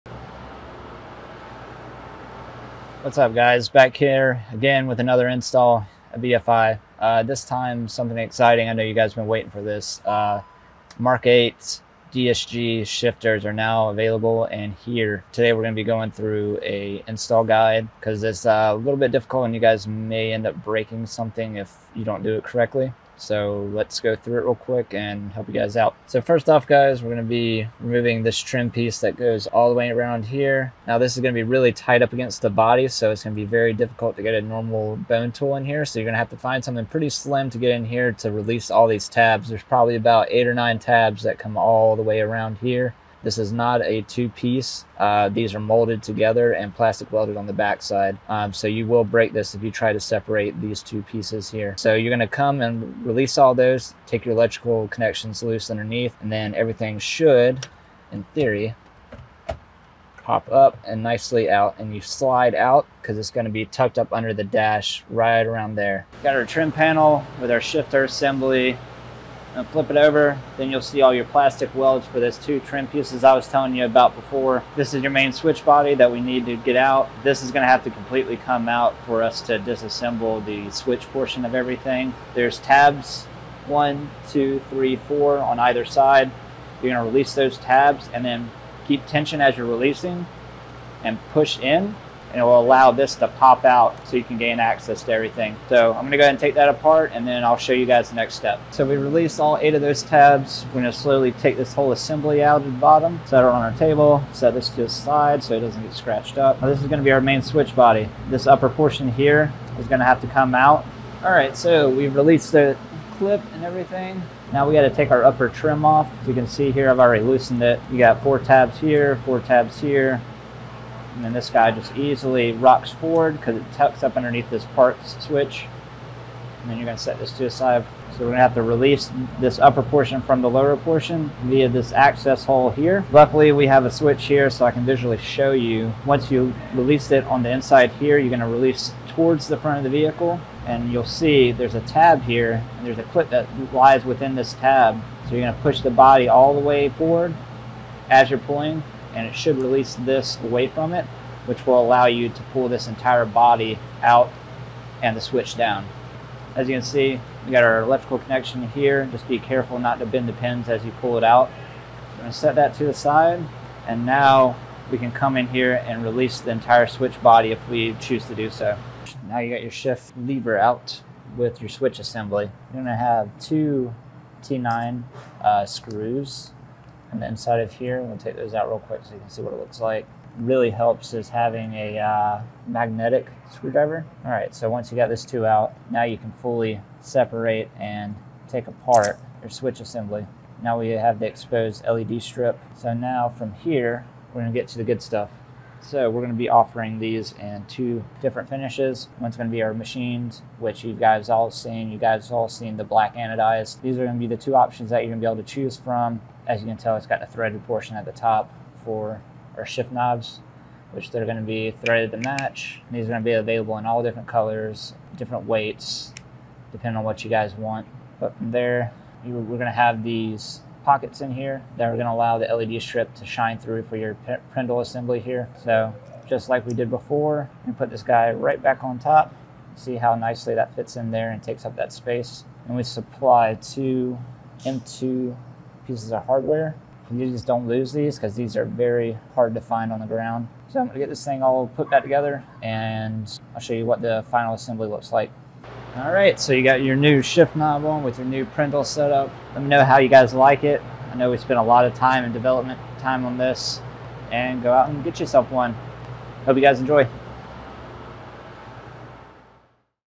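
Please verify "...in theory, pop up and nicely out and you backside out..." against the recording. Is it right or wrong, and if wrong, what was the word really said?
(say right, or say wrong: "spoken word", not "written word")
wrong: "slide", not "backside".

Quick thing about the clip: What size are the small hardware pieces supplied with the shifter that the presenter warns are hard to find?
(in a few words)
M2.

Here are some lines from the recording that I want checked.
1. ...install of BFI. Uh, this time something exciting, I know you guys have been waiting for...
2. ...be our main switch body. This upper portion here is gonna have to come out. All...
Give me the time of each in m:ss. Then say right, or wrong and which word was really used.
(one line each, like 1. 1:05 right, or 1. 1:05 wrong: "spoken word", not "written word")
1. 0:05 right
2. 1:47 right.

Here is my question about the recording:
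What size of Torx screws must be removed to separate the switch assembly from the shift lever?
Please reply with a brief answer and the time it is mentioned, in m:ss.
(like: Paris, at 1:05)
T9, at 2:54.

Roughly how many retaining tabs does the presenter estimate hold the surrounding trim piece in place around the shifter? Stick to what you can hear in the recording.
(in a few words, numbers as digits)
8 or 9.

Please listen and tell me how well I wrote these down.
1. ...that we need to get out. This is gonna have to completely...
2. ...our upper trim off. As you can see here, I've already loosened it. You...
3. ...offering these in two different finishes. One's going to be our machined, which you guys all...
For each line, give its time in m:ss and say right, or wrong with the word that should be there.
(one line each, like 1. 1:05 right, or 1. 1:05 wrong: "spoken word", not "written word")
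1. 1:15 right
2. 1:55 right
3. 3:16 right.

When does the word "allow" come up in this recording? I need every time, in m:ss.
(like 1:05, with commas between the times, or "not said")
1:32, 2:31, 3:42.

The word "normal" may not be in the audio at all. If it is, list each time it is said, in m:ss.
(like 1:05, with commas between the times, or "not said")
0:34.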